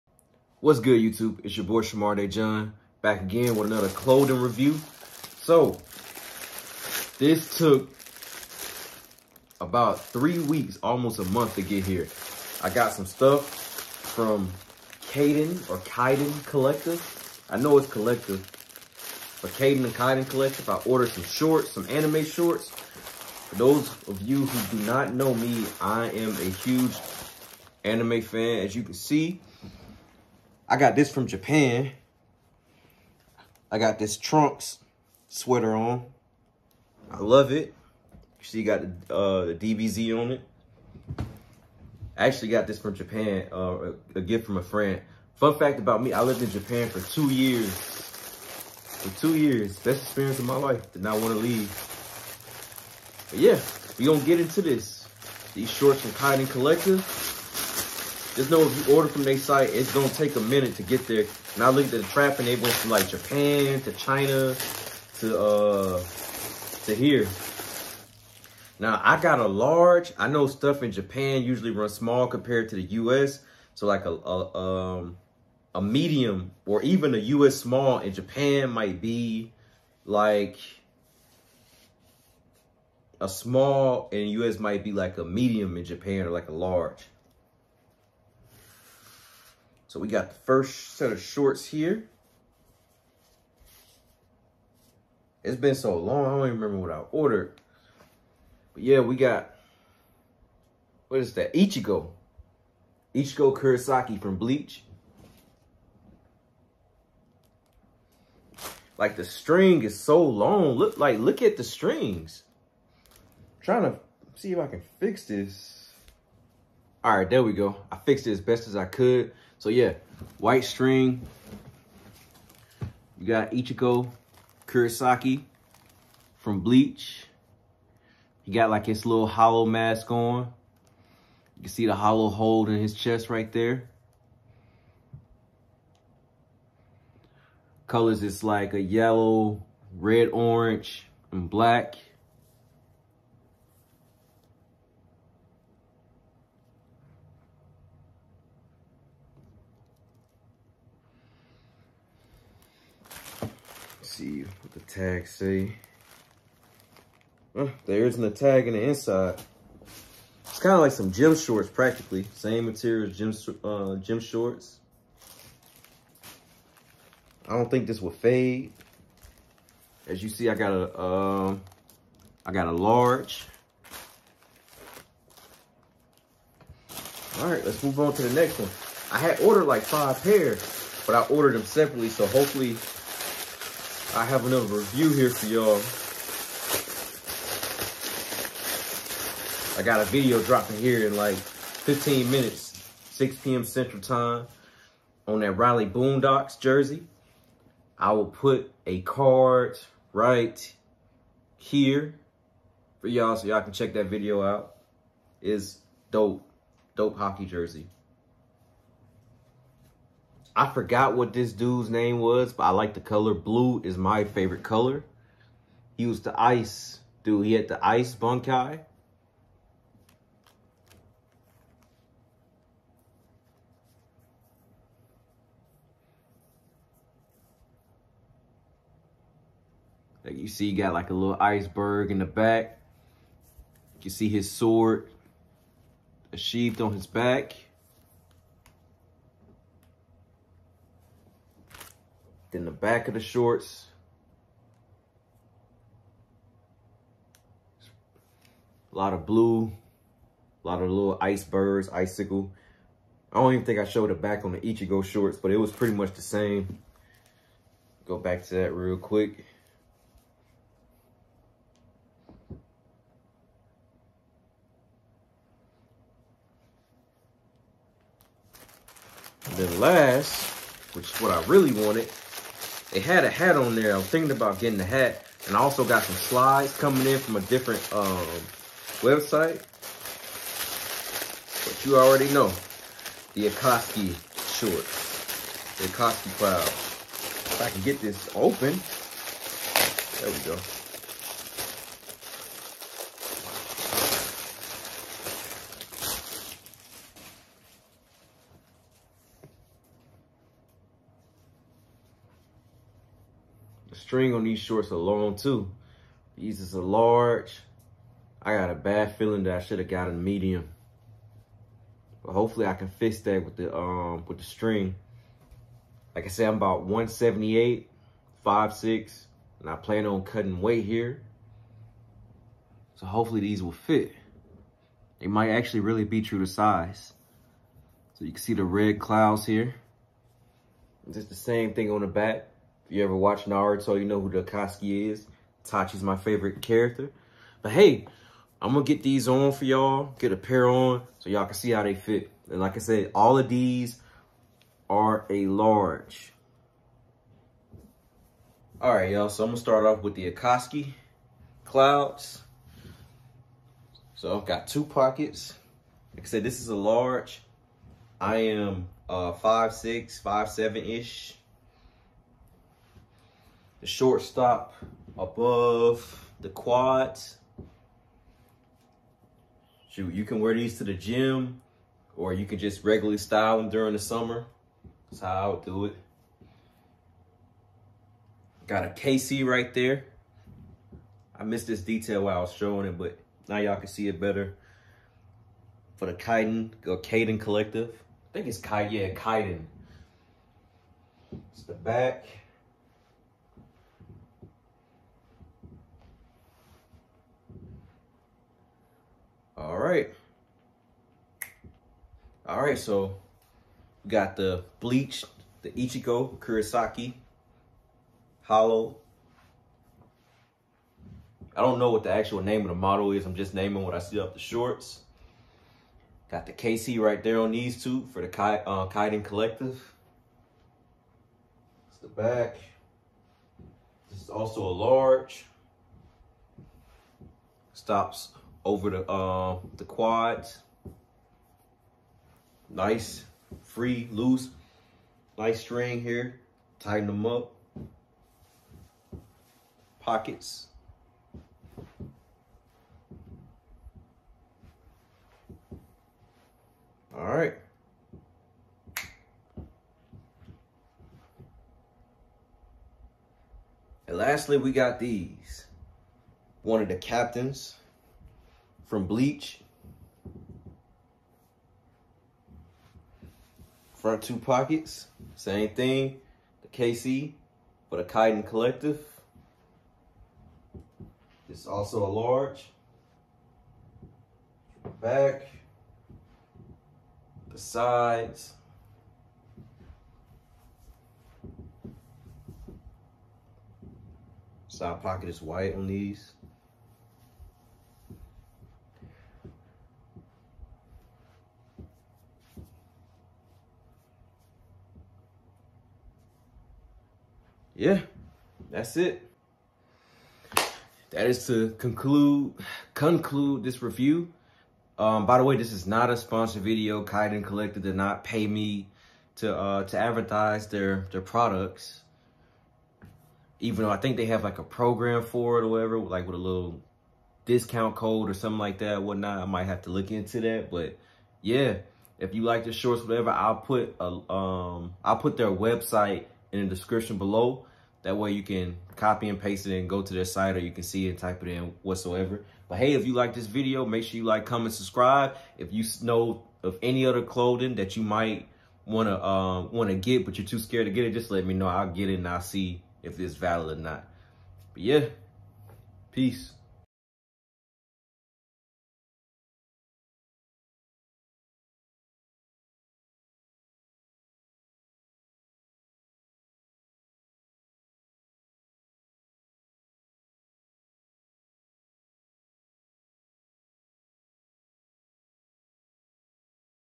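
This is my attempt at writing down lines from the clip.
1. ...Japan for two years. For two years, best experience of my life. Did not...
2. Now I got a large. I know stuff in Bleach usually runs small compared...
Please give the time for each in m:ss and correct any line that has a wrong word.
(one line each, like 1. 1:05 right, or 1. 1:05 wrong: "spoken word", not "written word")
1. 0:46 right
2. 1:08 wrong: "Japan", not "Bleach".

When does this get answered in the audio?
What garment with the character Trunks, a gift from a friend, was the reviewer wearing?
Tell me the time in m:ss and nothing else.
0:35.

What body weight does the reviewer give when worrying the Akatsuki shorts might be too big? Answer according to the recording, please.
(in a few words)
178.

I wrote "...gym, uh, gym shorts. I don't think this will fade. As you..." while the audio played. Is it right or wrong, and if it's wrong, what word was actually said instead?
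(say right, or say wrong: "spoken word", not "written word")
right.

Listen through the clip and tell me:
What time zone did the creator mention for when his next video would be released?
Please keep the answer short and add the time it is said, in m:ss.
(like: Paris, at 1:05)
Central Time, at 3:13.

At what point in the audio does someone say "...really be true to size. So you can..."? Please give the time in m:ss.
5:25.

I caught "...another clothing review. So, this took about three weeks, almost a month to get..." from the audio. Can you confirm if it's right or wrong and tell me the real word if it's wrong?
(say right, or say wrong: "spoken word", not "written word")
right.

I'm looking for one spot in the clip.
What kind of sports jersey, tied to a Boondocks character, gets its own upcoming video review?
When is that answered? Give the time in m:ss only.
3:27.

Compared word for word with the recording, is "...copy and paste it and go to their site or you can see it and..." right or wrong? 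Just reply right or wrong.
right.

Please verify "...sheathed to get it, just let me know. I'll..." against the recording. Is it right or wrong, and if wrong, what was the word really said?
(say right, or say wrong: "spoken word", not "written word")
wrong: "scared", not "sheathed".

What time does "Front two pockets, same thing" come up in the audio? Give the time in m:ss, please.
7:43.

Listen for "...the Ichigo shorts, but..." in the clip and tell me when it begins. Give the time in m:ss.
4:14.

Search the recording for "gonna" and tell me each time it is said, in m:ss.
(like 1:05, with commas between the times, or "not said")
0:54, 0:59.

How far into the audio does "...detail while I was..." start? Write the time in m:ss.
6:21.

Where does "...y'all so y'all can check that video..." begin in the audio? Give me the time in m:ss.
3:23.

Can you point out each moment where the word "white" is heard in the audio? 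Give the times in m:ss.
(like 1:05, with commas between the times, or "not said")
2:00, 8:05.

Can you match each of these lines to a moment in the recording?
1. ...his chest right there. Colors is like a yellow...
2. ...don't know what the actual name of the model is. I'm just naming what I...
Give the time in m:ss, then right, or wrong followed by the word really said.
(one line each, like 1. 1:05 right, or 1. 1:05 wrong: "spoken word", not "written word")
1. 2:12 right
2. 6:51 right.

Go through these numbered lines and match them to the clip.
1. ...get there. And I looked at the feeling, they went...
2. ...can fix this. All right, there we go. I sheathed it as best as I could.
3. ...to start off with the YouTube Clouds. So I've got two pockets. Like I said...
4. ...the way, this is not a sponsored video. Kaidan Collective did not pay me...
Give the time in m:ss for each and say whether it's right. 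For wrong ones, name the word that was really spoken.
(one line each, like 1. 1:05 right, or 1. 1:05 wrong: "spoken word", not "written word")
1. 1:00 wrong: "trapping", not "feeling"
2. 1:54 wrong: "fixed", not "sheathed"
3. 5:49 wrong: "Akatsuki", not "YouTube"
4. 8:25 right.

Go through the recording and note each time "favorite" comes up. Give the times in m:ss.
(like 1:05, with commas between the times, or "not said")
3:34, 5:36.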